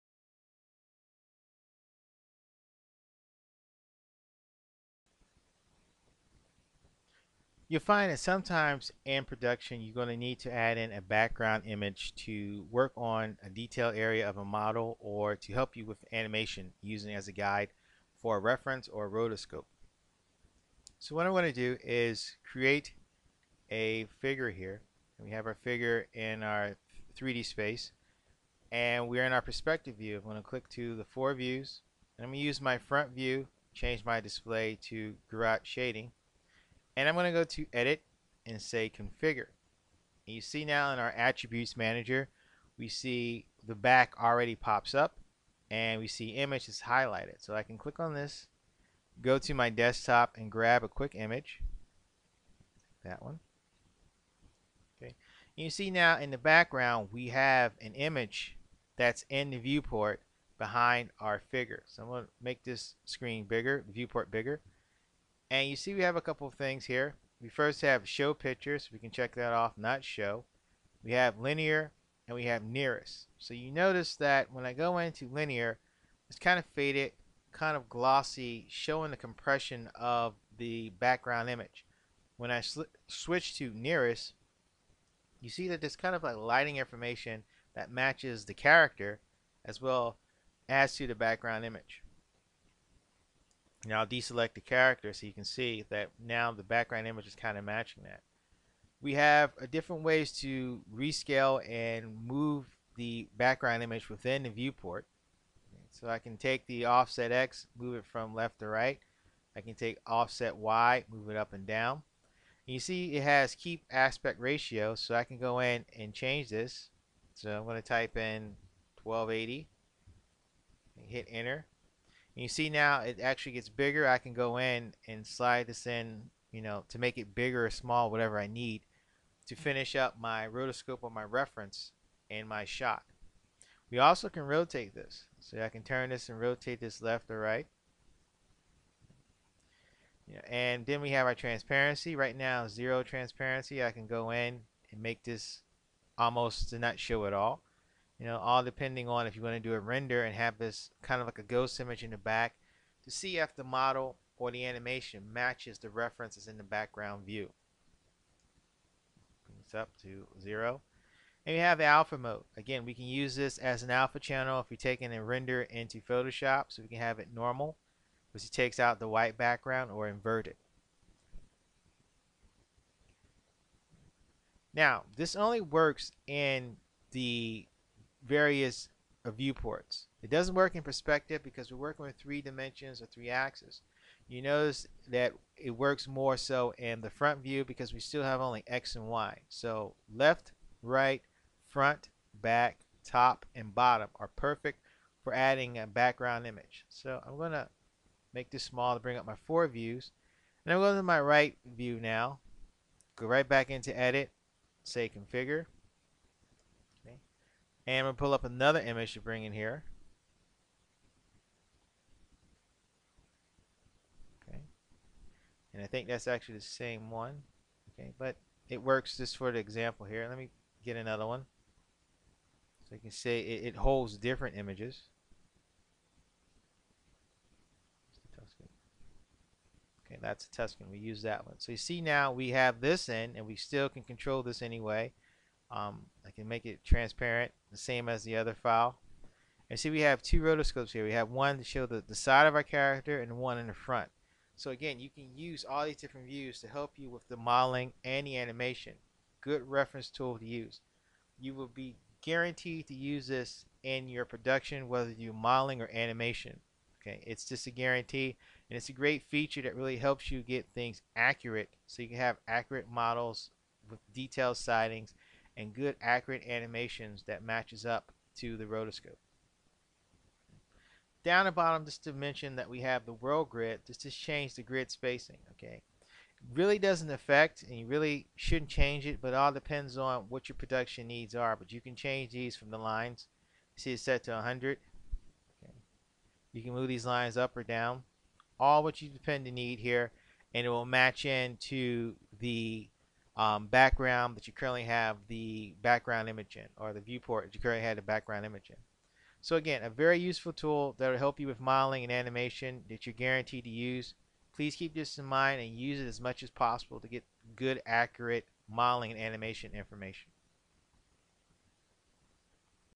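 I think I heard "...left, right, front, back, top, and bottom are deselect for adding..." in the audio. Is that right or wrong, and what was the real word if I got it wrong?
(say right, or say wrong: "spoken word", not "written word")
wrong: "perfect", not "deselect".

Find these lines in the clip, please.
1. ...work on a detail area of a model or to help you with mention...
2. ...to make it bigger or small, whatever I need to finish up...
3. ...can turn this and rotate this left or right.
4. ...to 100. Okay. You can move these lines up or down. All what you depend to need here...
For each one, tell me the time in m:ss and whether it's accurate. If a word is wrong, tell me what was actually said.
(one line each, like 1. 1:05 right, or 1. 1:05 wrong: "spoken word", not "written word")
1. 0:12 wrong: "animation", not "mention"
2. 2:06 right
3. 2:15 right
4. 4:44 right.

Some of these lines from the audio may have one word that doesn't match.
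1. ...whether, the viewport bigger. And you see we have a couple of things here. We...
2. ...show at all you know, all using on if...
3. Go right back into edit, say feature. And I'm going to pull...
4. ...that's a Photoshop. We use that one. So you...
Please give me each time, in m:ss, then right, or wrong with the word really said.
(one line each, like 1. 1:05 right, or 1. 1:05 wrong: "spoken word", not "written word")
1. 1:03 wrong: "bigger", not "whether"
2. 2:26 wrong: "depending", not "using"
3. 3:23 wrong: "configure", not "feature"
4. 3:50 wrong: "Tuscan", not "Photoshop".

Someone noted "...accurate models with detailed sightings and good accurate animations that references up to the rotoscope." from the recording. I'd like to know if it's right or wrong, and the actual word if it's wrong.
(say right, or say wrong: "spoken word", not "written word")
wrong: "matches", not "references".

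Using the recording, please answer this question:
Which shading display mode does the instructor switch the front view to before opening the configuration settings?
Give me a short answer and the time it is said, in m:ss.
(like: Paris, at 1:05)
Gouraud shading, at 0:35.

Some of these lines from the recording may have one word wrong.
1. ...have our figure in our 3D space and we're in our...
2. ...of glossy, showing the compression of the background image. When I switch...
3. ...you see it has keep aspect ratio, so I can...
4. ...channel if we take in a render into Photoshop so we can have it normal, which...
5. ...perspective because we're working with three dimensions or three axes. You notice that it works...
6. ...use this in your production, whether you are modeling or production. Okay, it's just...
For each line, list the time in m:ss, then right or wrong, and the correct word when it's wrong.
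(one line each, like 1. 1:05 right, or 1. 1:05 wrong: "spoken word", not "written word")
1. 0:25 right
2. 1:17 right
3. 1:52 right
4. 2:44 right
5. 3:00 right
6. 4:12 wrong: "animation", not "production".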